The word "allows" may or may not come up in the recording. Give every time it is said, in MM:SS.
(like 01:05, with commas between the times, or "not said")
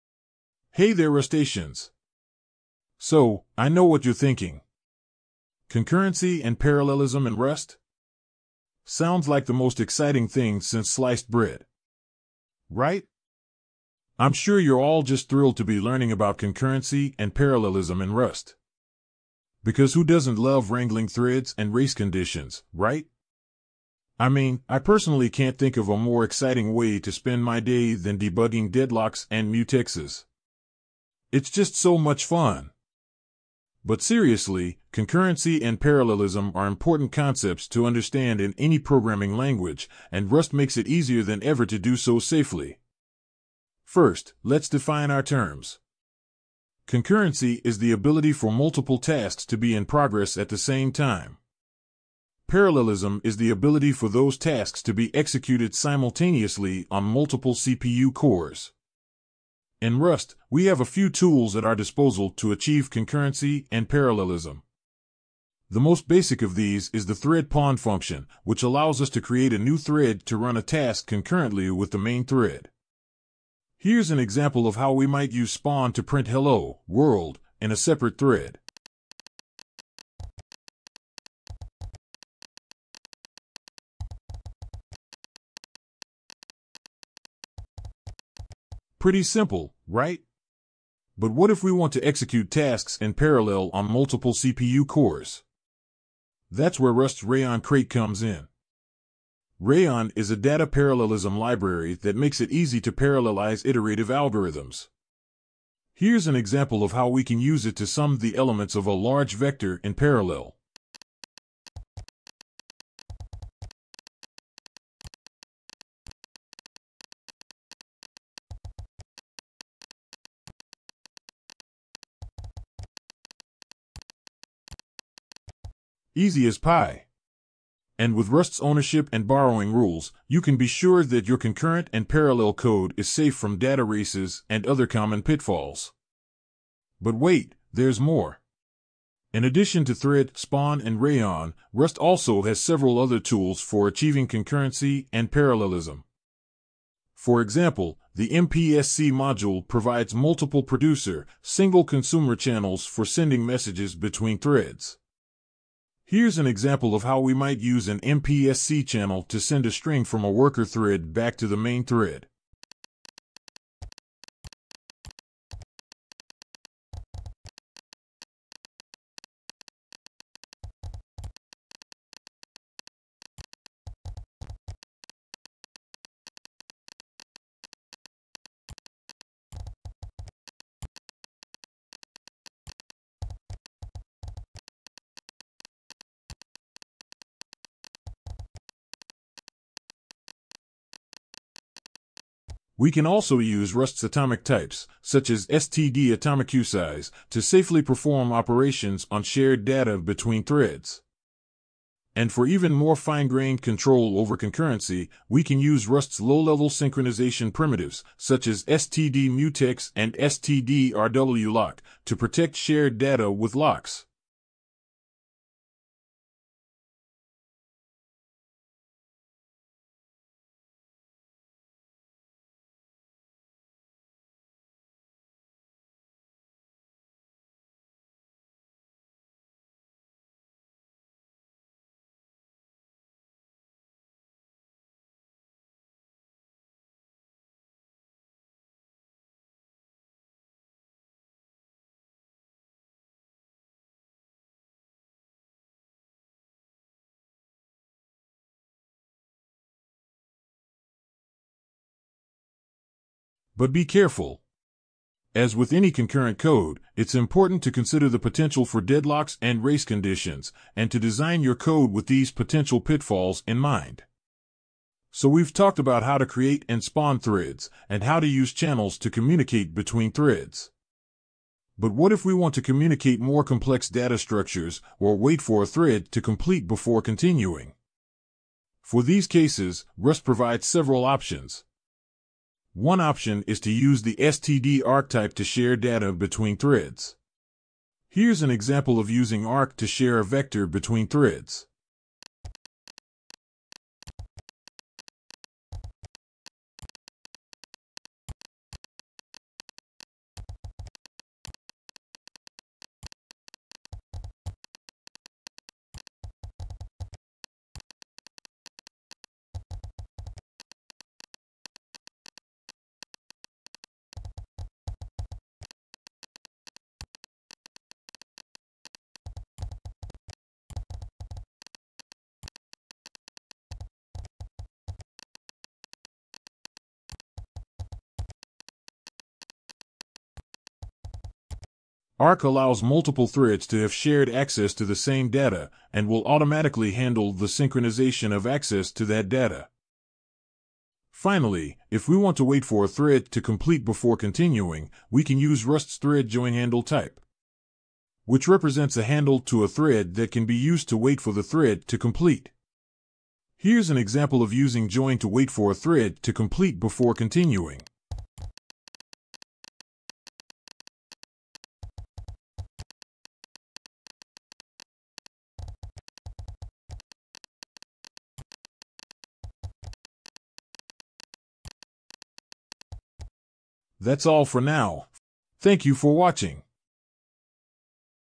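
01:08, 05:32.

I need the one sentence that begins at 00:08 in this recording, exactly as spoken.
Sounds like the most exciting thing since sliced bread.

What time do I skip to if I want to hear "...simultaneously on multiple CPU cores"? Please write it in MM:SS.
00:55.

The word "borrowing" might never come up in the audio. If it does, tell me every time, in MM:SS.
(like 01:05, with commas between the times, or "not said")
02:09.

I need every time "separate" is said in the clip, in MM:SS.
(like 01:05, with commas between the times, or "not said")
01:17.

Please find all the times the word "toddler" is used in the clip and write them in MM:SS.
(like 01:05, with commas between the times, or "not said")
not said.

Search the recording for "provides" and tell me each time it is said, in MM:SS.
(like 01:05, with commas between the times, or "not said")
02:29, 04:40.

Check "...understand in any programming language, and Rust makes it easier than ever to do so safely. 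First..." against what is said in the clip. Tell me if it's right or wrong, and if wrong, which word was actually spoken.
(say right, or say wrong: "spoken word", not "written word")
right.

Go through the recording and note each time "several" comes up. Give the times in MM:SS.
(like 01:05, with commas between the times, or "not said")
02:22, 04:40.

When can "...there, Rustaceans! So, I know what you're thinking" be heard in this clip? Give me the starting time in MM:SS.
00:00.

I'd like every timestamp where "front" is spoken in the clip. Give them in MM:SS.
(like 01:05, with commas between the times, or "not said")
not said.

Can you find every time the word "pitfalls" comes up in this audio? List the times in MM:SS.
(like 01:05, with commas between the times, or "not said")
02:15, 04:22.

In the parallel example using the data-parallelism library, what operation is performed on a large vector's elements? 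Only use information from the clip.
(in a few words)
Sum.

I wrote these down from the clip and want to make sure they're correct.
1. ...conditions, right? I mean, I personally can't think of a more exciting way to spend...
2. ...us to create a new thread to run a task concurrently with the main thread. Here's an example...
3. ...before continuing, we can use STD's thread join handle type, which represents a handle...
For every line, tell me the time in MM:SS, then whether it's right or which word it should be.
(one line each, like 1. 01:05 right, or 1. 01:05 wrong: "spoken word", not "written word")
1. 00:21 right
2. 01:09 right
3. 05:43 wrong: "Rust", not "STD".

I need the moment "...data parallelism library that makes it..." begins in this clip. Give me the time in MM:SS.
01:40.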